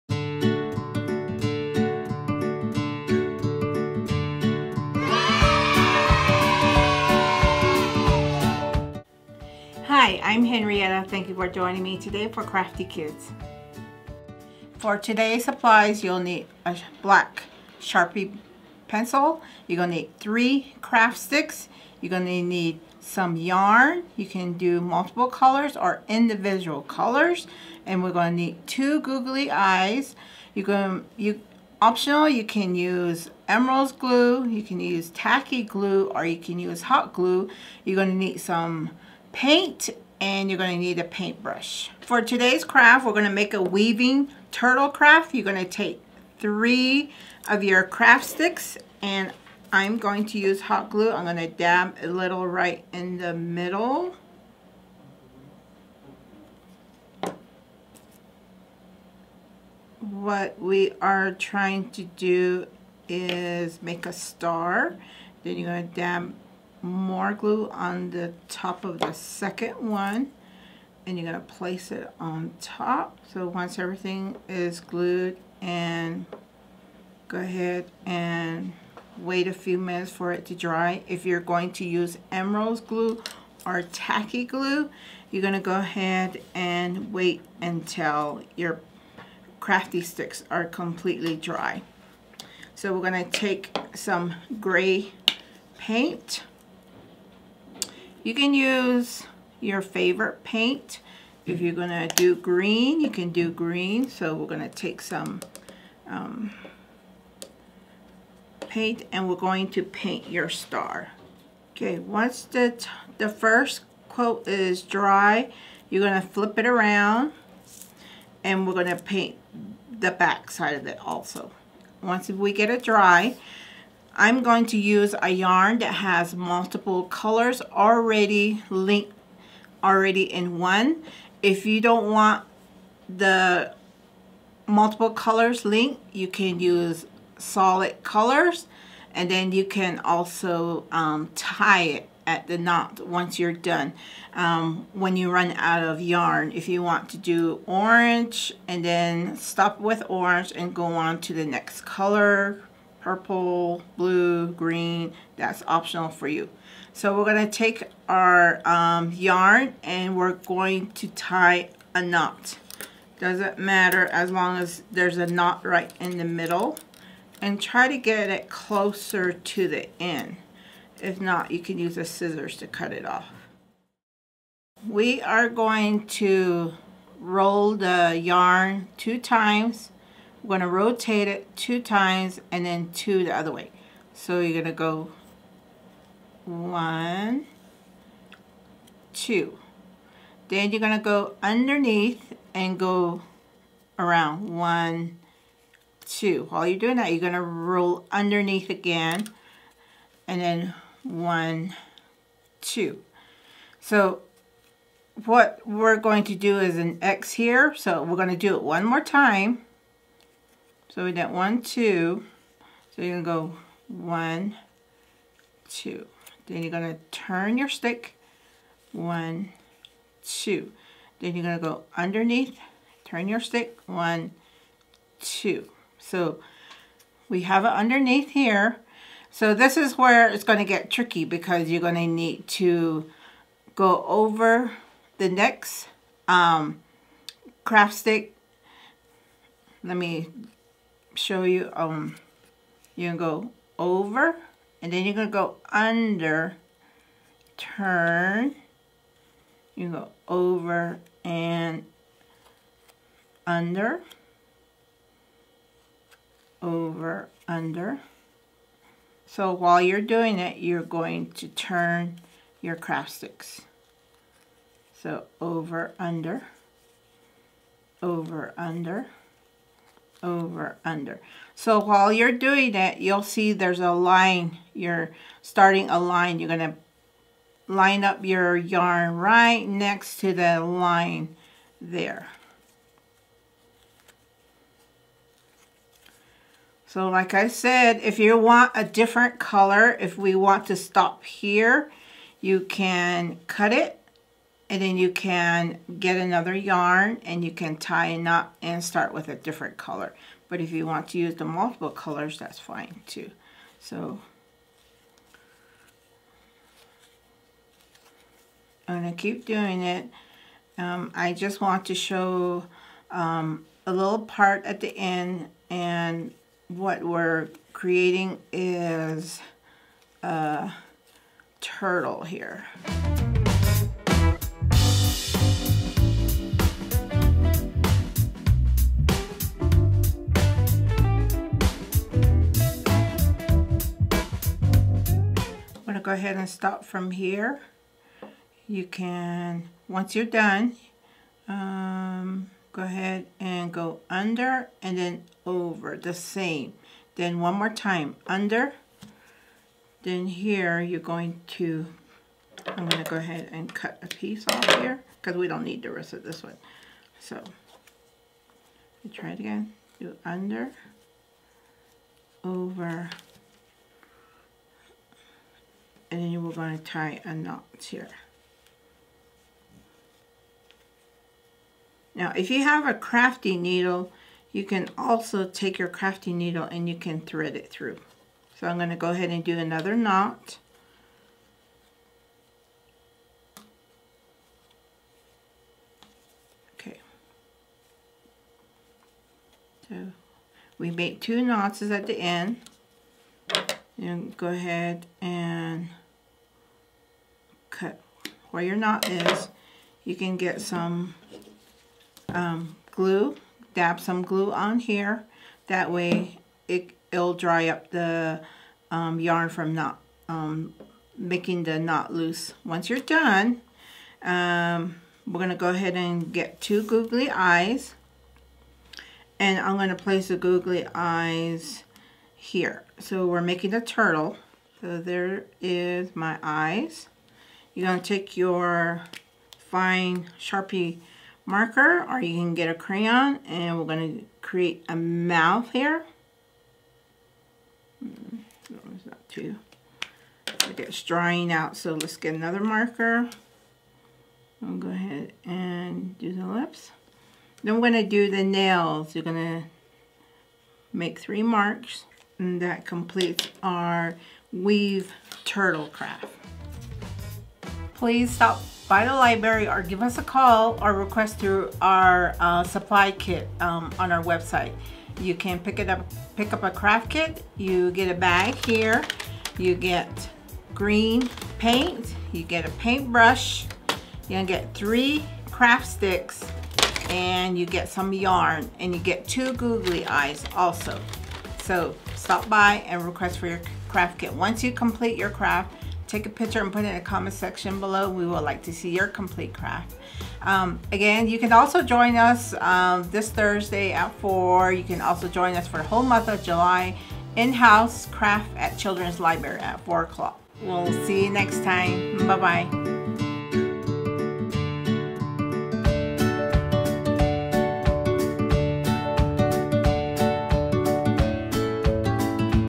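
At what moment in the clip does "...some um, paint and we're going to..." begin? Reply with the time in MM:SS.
01:45.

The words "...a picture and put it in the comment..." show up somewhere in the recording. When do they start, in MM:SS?
08:06.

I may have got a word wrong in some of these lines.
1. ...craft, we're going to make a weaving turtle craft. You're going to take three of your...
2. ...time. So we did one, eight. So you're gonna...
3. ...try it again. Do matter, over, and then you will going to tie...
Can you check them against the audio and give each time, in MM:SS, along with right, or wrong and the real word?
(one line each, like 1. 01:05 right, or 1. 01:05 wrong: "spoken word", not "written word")
1. 00:42 right
2. 03:29 wrong: "two", not "eight"
3. 05:59 wrong: "under", not "matter".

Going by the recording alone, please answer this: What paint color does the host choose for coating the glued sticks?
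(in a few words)
Gray.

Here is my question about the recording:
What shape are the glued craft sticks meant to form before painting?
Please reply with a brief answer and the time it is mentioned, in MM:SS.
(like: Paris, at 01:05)
A star, at 01:04.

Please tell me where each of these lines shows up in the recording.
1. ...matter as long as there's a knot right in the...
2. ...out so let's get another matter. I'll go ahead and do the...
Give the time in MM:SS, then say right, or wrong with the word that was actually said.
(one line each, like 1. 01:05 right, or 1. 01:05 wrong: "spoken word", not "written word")
1. 02:43 right
2. 07:21 wrong: "marker", not "matter".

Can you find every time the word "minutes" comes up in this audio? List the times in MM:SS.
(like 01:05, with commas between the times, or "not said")
01:19.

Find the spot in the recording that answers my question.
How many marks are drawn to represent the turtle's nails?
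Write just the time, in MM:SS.
07:31.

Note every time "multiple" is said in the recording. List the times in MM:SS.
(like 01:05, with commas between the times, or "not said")
00:24, 02:06, 02:14, 05:01.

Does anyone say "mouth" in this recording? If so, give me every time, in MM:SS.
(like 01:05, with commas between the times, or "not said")
07:14.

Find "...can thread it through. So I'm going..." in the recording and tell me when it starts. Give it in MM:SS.
06:16.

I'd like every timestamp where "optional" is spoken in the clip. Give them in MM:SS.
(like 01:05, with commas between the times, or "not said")
00:31, 02:35.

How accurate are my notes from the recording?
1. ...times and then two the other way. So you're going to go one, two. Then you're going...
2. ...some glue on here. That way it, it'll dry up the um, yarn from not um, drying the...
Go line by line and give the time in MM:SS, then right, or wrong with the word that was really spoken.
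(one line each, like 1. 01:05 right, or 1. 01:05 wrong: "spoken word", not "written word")
1. 03:01 right
2. 06:43 wrong: "making", not "drying".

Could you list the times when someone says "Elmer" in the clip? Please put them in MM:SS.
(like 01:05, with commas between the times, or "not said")
00:33, 01:22.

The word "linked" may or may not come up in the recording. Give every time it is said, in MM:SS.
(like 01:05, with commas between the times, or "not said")
02:08, 02:15.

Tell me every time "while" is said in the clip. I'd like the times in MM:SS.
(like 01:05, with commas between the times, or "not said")
03:16, 04:19, 04:31.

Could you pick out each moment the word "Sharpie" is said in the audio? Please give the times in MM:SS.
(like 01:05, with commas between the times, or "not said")
00:17, 07:10.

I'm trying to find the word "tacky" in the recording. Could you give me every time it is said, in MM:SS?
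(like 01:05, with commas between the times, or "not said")
00:35, 01:23.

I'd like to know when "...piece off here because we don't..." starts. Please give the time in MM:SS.
05:54.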